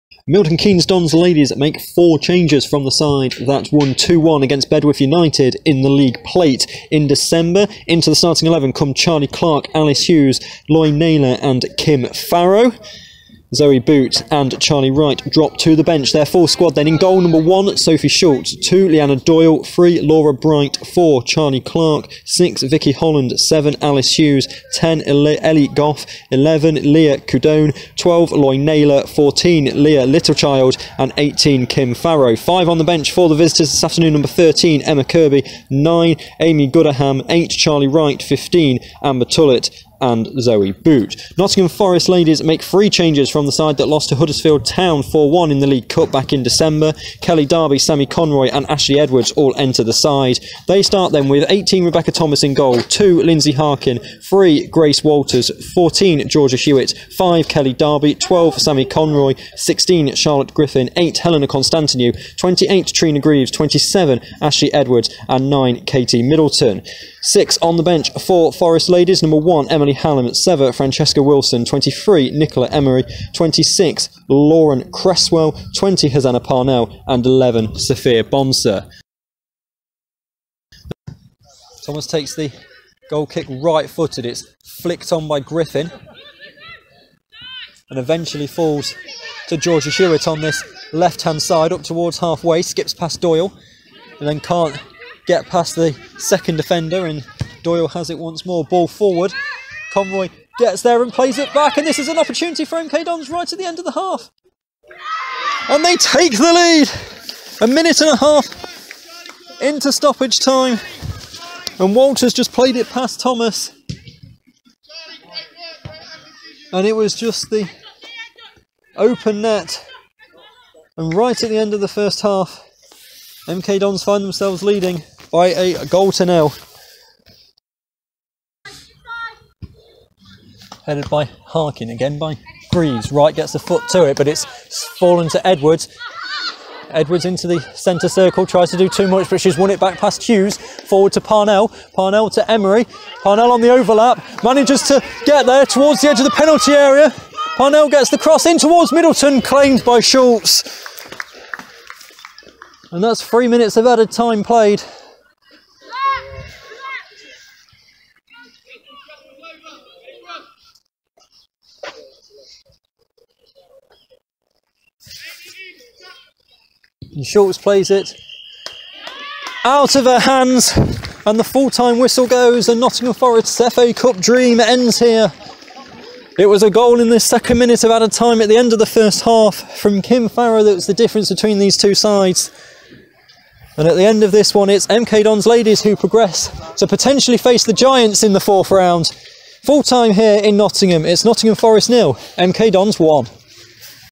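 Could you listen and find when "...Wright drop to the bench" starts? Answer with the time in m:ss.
0:14.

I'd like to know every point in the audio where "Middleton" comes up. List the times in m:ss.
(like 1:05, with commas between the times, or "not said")
1:06, 2:28.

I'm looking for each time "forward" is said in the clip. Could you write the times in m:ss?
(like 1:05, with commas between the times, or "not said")
1:38, 2:20.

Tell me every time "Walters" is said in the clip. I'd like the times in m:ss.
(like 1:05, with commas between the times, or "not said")
0:55, 1:51.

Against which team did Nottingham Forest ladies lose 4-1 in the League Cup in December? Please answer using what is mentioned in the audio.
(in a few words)
Huddersfield Town.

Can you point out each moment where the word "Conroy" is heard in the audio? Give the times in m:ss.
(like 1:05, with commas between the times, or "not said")
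0:48, 0:58, 1:39.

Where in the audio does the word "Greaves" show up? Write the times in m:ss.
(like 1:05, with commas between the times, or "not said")
1:03, 2:12.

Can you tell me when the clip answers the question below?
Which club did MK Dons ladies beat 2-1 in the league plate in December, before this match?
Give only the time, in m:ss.
0:04.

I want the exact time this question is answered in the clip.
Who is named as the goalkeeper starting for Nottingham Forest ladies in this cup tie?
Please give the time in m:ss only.
0:51.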